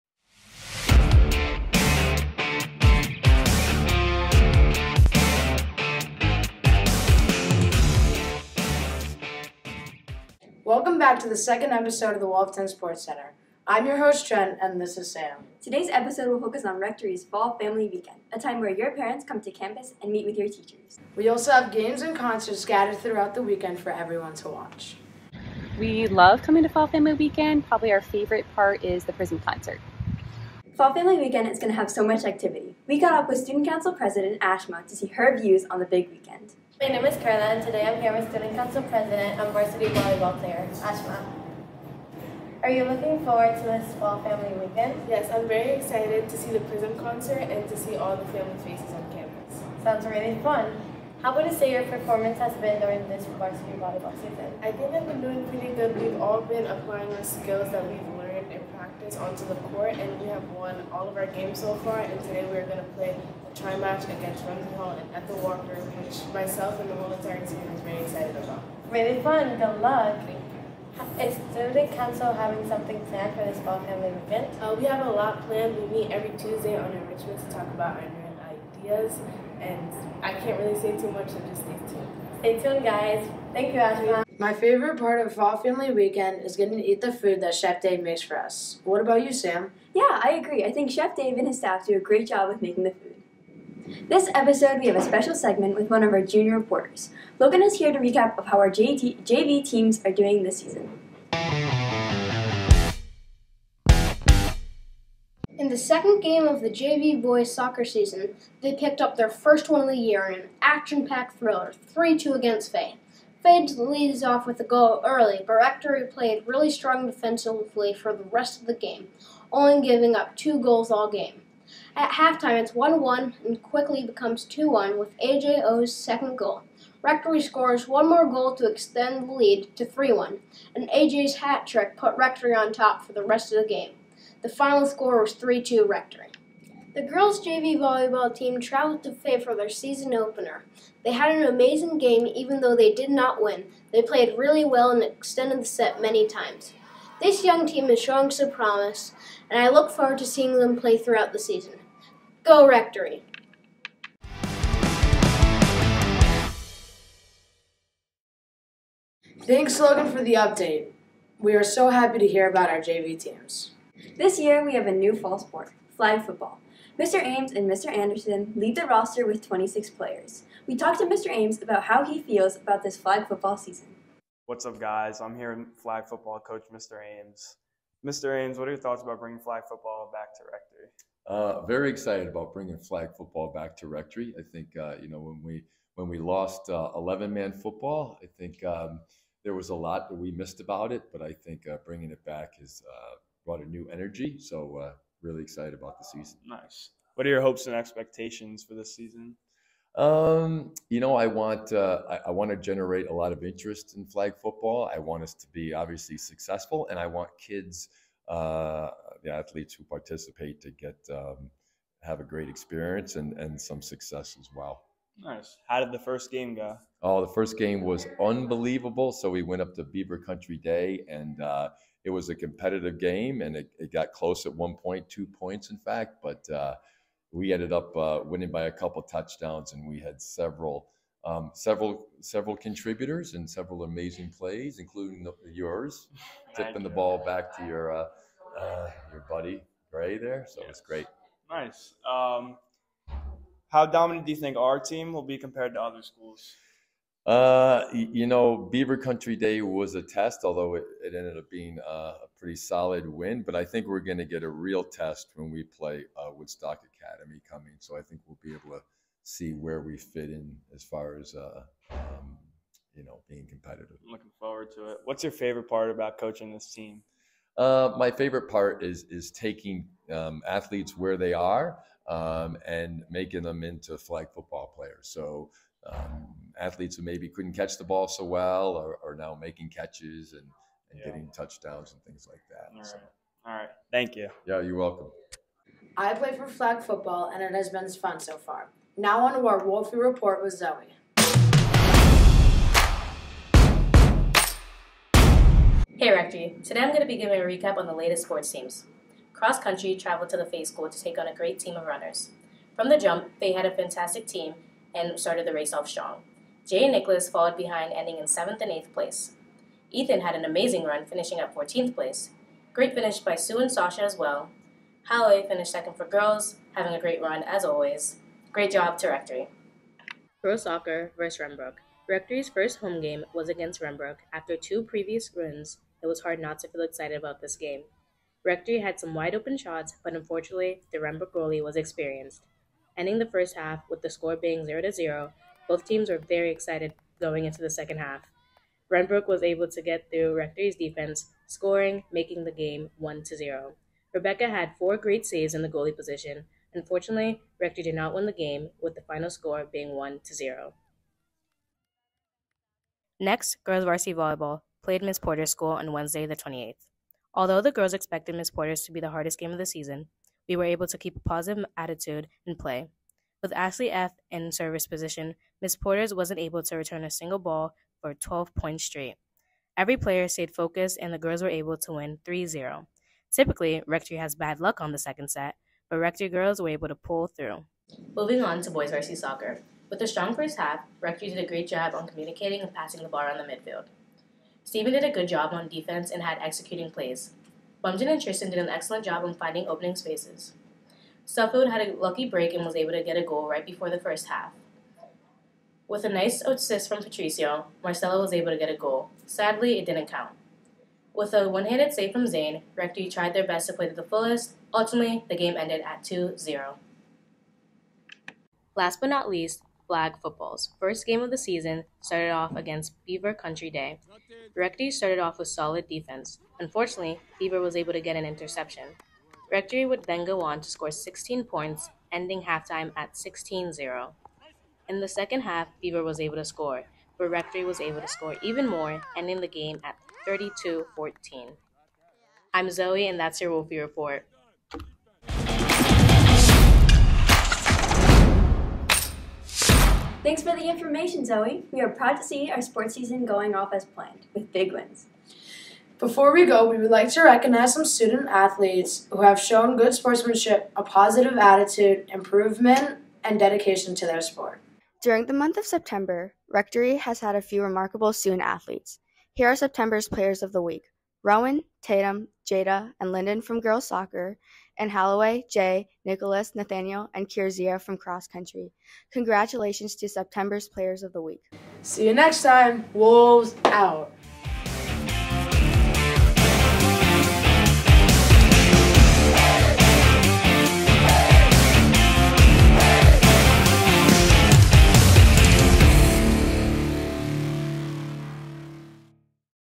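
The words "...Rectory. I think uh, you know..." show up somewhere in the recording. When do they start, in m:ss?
3:03.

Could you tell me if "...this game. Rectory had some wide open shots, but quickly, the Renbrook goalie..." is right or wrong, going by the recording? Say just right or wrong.
wrong.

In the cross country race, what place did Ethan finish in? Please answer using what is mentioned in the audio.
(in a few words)
14th.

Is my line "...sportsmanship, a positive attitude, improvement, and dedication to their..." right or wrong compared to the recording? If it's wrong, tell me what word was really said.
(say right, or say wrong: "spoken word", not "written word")
right.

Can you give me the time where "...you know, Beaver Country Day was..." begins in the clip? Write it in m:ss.
4:07.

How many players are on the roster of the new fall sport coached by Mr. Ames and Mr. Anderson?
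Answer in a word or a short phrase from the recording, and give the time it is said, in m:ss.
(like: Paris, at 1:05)
26, at 2:49.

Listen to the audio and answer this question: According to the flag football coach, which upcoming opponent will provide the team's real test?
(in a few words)
Woodstock Academy.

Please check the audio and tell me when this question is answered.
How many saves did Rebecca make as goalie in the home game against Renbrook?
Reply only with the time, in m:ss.
5:44.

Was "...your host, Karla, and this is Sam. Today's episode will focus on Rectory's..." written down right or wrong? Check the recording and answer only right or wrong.
wrong.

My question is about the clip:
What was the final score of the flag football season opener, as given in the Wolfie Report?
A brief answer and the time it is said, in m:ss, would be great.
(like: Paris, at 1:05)
32-14, at 7:10.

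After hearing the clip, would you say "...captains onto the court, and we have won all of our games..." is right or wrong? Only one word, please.
right.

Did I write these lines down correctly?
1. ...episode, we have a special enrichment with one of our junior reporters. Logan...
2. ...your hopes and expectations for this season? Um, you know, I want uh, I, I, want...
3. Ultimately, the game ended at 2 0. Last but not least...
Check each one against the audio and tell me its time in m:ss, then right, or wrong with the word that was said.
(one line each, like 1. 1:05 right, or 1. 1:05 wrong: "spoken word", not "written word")
1. 1:34 wrong: "segment", not "enrichment"
2. 3:17 right
3. 6:44 right.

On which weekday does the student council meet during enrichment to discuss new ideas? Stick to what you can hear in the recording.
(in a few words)
Tuesday.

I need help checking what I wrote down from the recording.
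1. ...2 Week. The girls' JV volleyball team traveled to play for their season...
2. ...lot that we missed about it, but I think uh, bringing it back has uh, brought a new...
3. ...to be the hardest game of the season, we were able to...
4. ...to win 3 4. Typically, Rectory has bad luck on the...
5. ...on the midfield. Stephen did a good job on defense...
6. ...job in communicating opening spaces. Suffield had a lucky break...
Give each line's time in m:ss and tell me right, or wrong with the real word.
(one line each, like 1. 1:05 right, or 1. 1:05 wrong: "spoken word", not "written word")
1. 2:15 wrong: "Rectory", not "Week"
2. 3:09 right
3. 5:58 right
4. 6:11 wrong: "0", not "4"
5. 6:23 right
6. 6:29 wrong: "finding", not "communicating".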